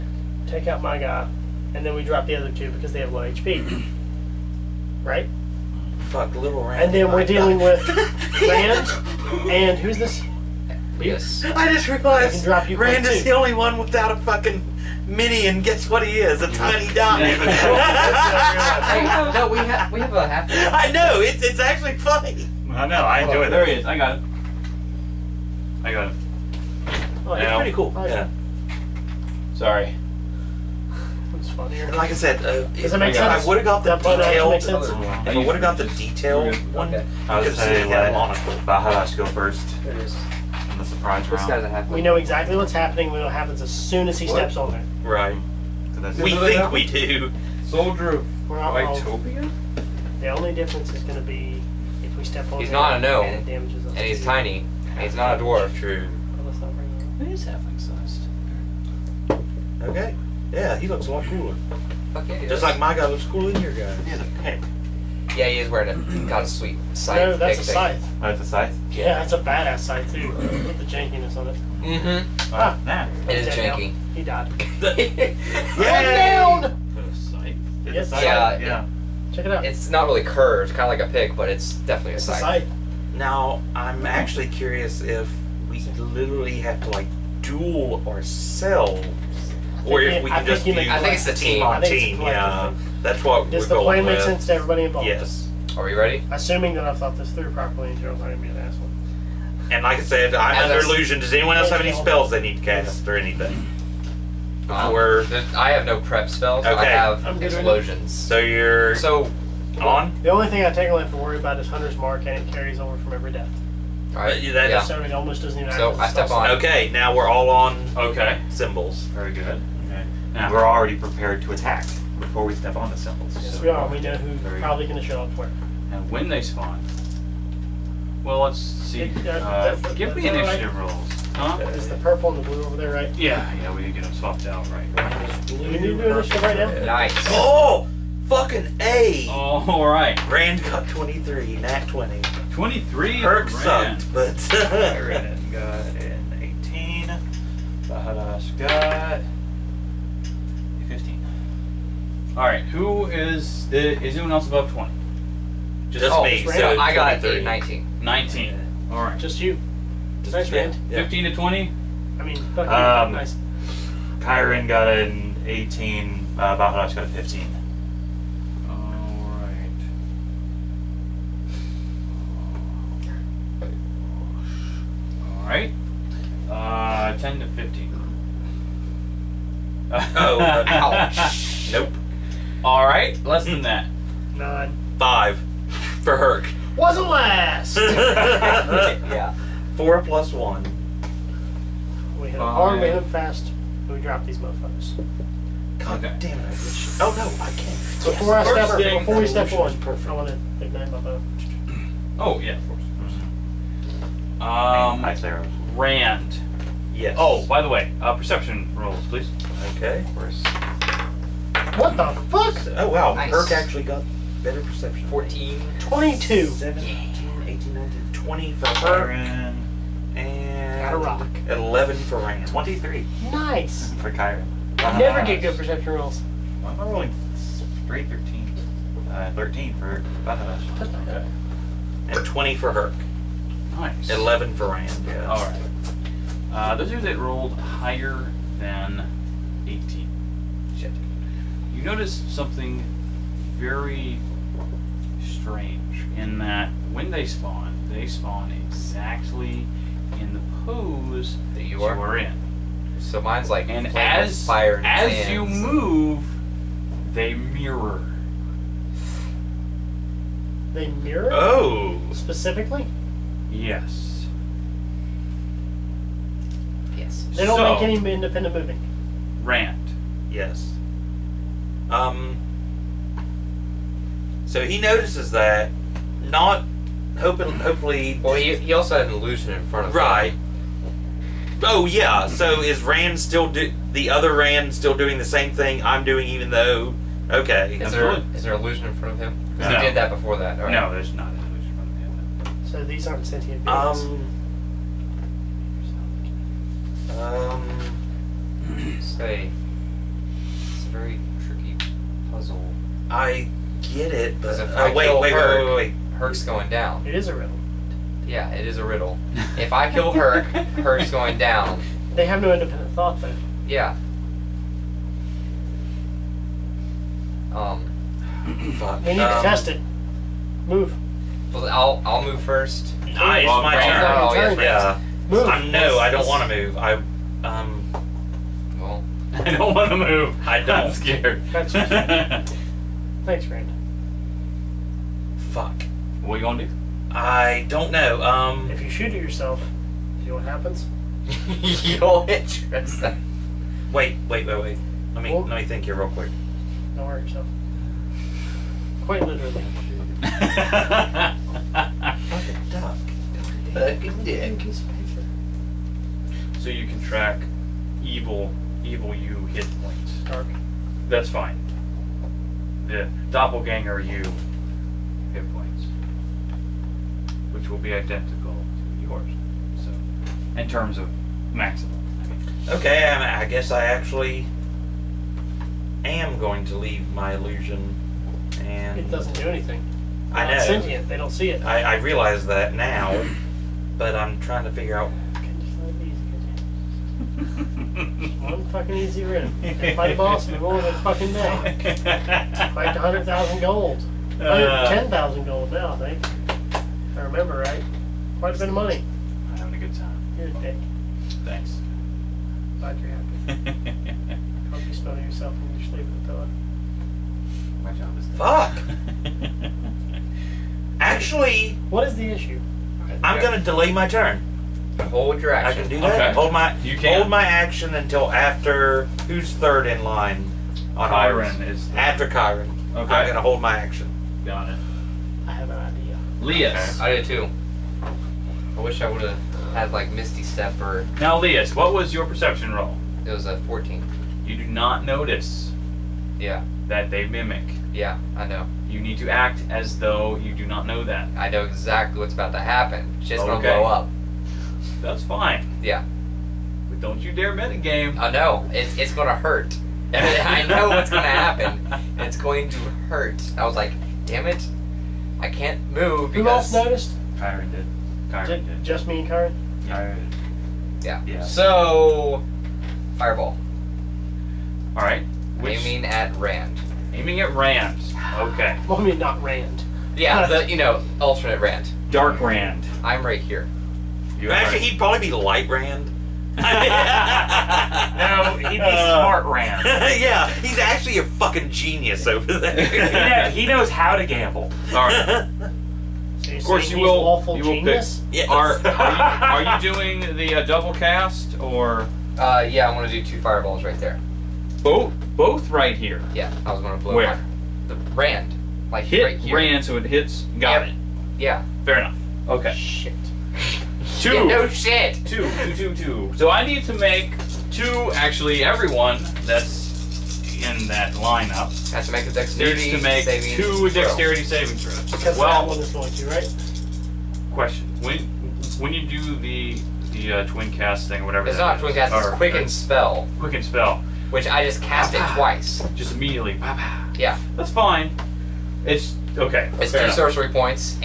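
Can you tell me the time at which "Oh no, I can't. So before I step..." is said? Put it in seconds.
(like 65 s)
196 s.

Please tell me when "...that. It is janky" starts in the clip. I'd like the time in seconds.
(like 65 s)
72 s.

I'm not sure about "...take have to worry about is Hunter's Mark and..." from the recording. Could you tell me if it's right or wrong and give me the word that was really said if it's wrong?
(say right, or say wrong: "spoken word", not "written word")
right.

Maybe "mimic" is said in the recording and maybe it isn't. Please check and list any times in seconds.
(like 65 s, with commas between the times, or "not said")
437 s.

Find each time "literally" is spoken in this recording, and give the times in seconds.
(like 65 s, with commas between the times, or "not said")
85 s, 349 s.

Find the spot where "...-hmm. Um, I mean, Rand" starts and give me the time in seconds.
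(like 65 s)
204 s.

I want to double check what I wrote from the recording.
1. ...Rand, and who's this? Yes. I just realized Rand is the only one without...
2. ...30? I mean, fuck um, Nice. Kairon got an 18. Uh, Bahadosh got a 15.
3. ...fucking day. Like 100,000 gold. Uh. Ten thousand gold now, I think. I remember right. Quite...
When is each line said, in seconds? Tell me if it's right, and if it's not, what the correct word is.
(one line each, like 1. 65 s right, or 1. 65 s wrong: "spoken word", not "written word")
1. 8 s right
2. 161 s wrong: "20", not "30"
3. 390 s right.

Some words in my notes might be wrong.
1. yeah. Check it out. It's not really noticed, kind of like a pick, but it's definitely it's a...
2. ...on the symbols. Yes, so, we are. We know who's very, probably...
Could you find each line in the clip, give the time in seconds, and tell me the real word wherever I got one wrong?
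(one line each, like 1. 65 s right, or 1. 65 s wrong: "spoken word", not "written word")
1. 78 s wrong: "curved", not "noticed"
2. 122 s right.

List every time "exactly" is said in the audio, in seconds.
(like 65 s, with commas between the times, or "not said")
42 s, 248 s, 441 s.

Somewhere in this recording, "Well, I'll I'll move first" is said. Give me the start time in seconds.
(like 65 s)
321 s.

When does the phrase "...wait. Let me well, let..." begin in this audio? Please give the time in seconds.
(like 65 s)
344 s.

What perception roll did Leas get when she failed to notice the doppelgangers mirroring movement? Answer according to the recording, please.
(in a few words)
14.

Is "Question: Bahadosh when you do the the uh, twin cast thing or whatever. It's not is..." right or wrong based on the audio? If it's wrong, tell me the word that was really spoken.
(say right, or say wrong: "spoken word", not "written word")
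wrong: "When", not "Bahadosh".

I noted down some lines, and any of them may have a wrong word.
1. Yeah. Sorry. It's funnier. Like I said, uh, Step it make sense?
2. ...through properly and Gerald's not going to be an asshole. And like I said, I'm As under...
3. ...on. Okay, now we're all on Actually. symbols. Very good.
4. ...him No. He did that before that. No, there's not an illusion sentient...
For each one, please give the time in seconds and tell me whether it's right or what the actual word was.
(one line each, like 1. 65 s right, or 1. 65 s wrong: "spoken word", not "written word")
1. 27 s wrong: "Does", not "Step"
2. 97 s right
3. 116 s wrong: "Okay", not "Actually"
4. 289 s wrong: "front", not "sentient".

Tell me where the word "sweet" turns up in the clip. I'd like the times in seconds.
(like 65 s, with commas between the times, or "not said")
66 s.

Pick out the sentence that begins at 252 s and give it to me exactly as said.
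So mine's like and as fire and as you move, they mirror.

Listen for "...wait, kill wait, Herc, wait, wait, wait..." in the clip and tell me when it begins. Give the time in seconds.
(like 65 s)
304 s.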